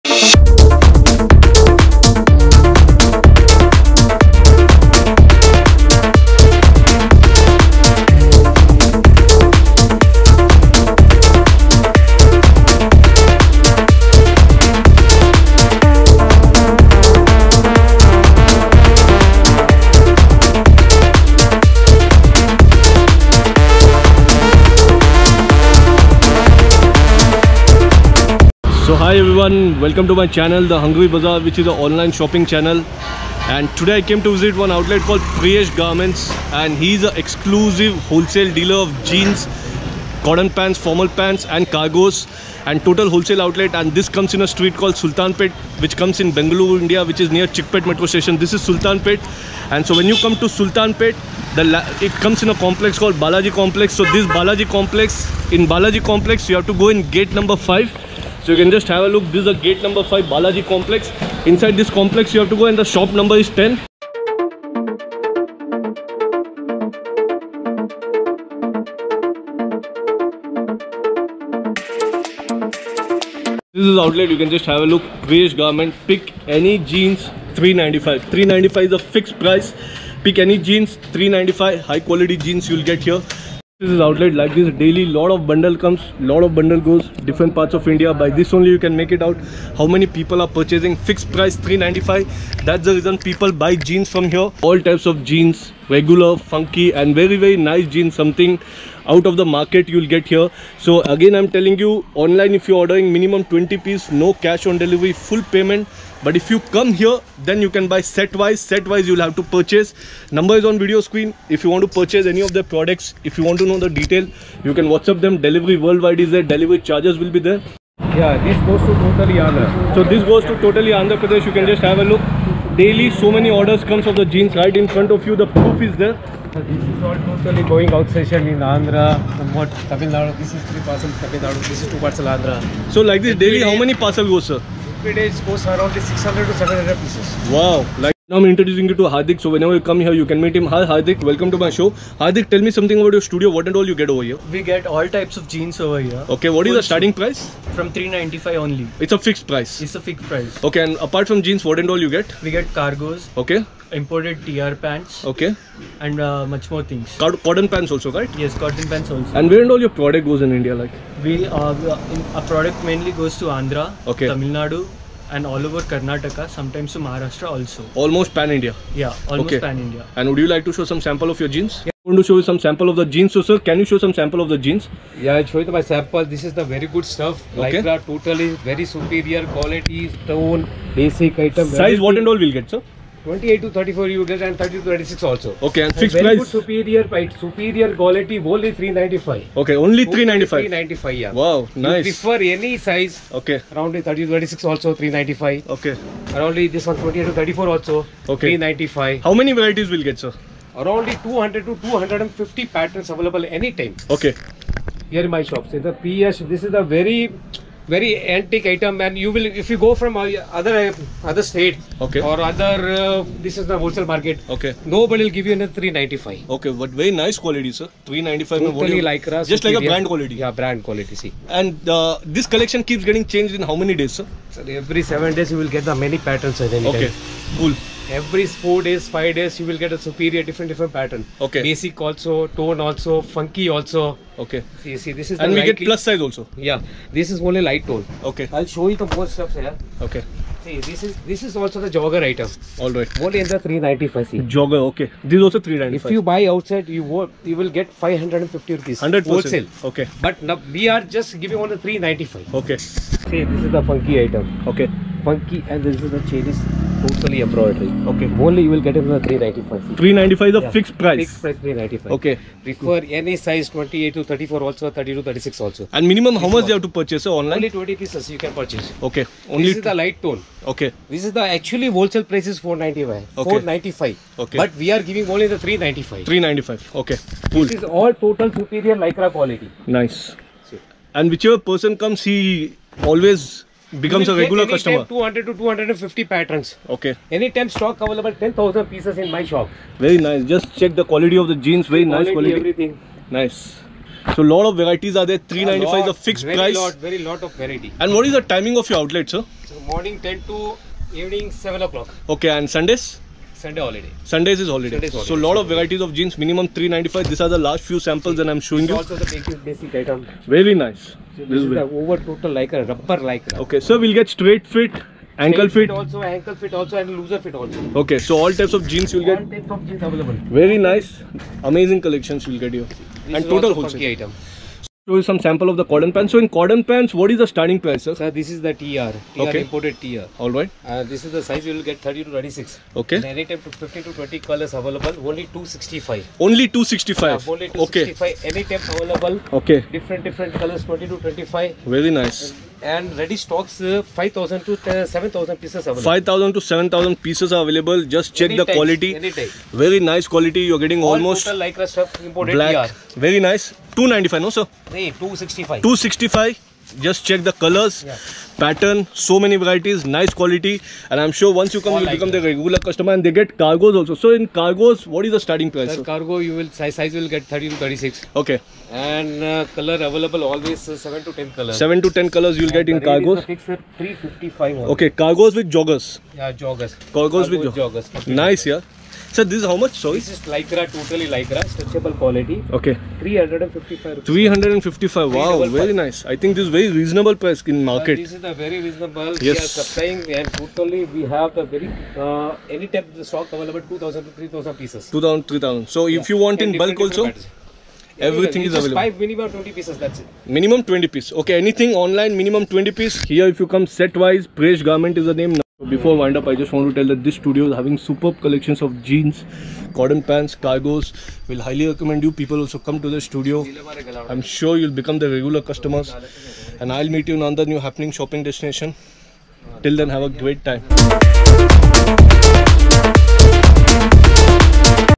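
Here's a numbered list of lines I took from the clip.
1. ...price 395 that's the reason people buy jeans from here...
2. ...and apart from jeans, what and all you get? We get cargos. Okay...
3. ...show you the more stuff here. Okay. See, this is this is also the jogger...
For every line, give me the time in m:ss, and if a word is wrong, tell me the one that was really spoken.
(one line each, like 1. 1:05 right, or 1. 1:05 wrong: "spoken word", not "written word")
1. 1:31 right
2. 2:30 right
3. 3:58 right.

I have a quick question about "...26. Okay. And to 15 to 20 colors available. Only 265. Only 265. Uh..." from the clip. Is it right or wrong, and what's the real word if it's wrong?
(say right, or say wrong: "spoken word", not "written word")
right.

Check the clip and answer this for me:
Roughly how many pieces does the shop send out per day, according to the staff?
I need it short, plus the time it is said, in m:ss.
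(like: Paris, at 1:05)
600 to 700, at 2:15.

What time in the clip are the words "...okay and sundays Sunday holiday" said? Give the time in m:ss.
5:02.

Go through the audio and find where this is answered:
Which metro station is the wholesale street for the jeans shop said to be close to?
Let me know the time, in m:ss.
0:47.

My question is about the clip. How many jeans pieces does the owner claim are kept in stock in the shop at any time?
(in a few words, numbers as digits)
10000.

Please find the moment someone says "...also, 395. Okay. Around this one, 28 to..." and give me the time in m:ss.
3:14.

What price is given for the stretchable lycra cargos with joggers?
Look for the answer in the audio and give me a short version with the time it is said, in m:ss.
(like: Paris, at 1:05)
355, at 6:12.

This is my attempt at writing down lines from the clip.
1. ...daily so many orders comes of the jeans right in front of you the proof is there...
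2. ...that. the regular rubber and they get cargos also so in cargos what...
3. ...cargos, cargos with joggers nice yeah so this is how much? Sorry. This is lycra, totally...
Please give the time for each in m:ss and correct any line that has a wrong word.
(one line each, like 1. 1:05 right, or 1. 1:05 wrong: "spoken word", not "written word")
1. 2:02 right
2. 6:02 wrong: "customer", not "rubber"
3. 6:17 right.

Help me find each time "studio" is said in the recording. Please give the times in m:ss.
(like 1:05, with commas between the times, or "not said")
2:23, 6:47, 6:53.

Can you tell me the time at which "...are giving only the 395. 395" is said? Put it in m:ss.
4:34.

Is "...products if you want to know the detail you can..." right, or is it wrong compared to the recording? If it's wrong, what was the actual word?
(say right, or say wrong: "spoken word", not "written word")
right.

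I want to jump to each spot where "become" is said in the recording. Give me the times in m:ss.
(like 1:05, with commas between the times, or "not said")
4:43, 6:02, 6:54.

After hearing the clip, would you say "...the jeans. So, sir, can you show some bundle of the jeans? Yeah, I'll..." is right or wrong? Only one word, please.
wrong.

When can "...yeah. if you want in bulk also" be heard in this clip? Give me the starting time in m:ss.
6:36.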